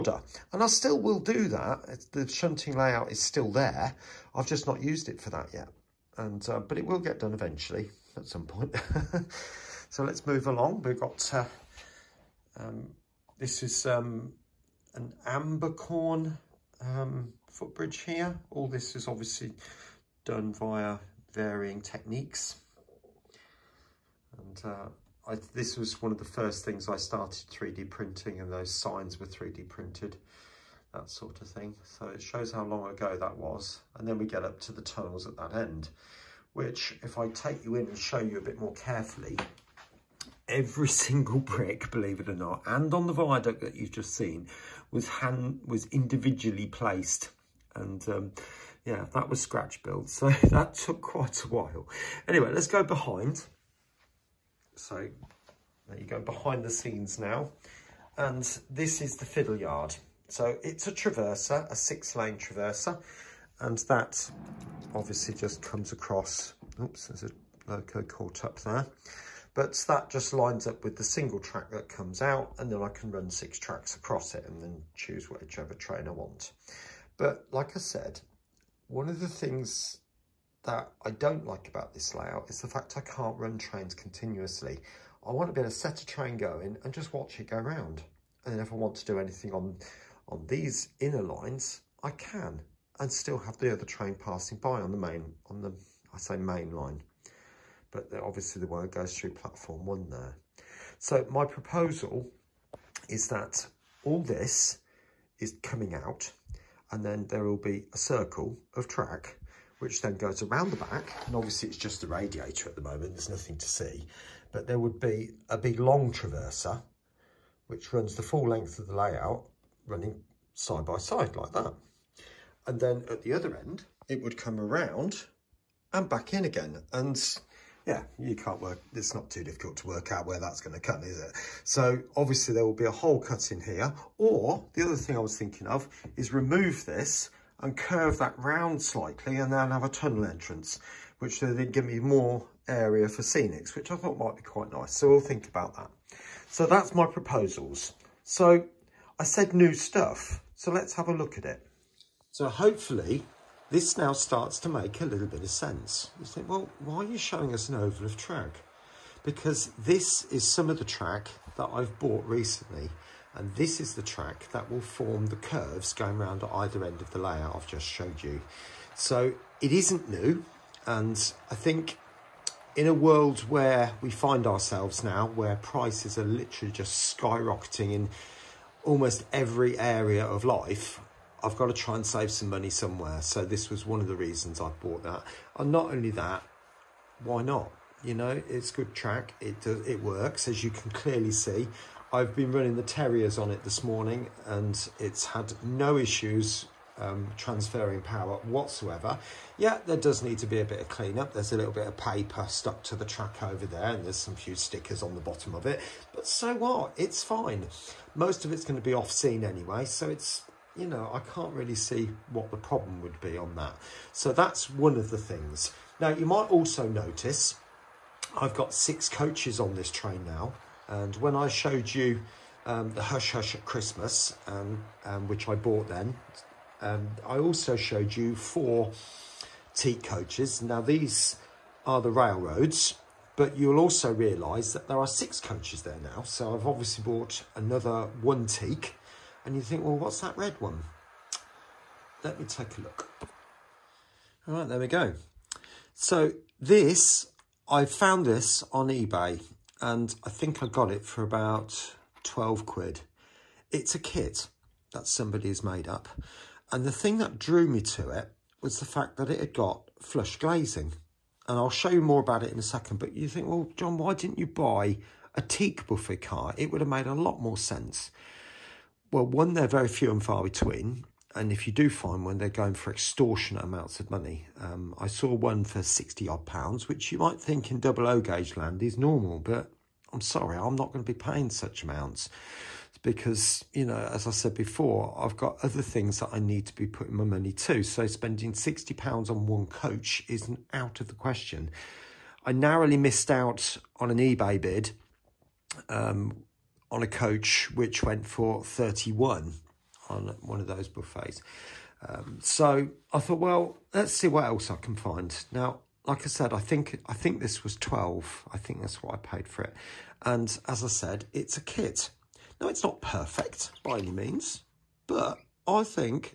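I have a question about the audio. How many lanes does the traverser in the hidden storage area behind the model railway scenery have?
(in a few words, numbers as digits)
6.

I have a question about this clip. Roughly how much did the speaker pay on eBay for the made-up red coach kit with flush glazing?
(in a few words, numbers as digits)
£12.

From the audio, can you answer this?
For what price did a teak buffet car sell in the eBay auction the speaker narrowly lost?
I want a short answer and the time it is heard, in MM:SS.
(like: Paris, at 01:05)
£31, at 04:58.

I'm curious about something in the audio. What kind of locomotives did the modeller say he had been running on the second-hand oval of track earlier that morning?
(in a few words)
Terriers.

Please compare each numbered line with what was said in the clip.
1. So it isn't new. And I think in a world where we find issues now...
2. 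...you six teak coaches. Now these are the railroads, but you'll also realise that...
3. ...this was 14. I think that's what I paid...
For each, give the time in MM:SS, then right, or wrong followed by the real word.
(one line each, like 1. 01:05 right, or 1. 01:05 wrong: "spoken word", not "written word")
1. 02:48 wrong: "ourselves", not "issues"
2. 03:48 wrong: "four", not "six"
3. 05:07 wrong: "12", not "14".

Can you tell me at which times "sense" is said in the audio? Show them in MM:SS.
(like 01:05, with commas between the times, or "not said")
02:35, 04:27.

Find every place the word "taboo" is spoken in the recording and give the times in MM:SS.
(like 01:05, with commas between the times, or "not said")
not said.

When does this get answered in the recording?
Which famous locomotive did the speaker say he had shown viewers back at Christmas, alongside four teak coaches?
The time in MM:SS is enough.
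03:43.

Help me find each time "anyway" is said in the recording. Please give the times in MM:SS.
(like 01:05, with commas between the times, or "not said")
00:52, 03:29.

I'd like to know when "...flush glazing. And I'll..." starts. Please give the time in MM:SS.
04:20.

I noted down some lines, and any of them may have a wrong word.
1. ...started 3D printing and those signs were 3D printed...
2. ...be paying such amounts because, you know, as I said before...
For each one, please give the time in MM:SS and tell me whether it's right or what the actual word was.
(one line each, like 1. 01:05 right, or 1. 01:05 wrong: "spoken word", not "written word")
1. 00:26 right
2. 04:41 right.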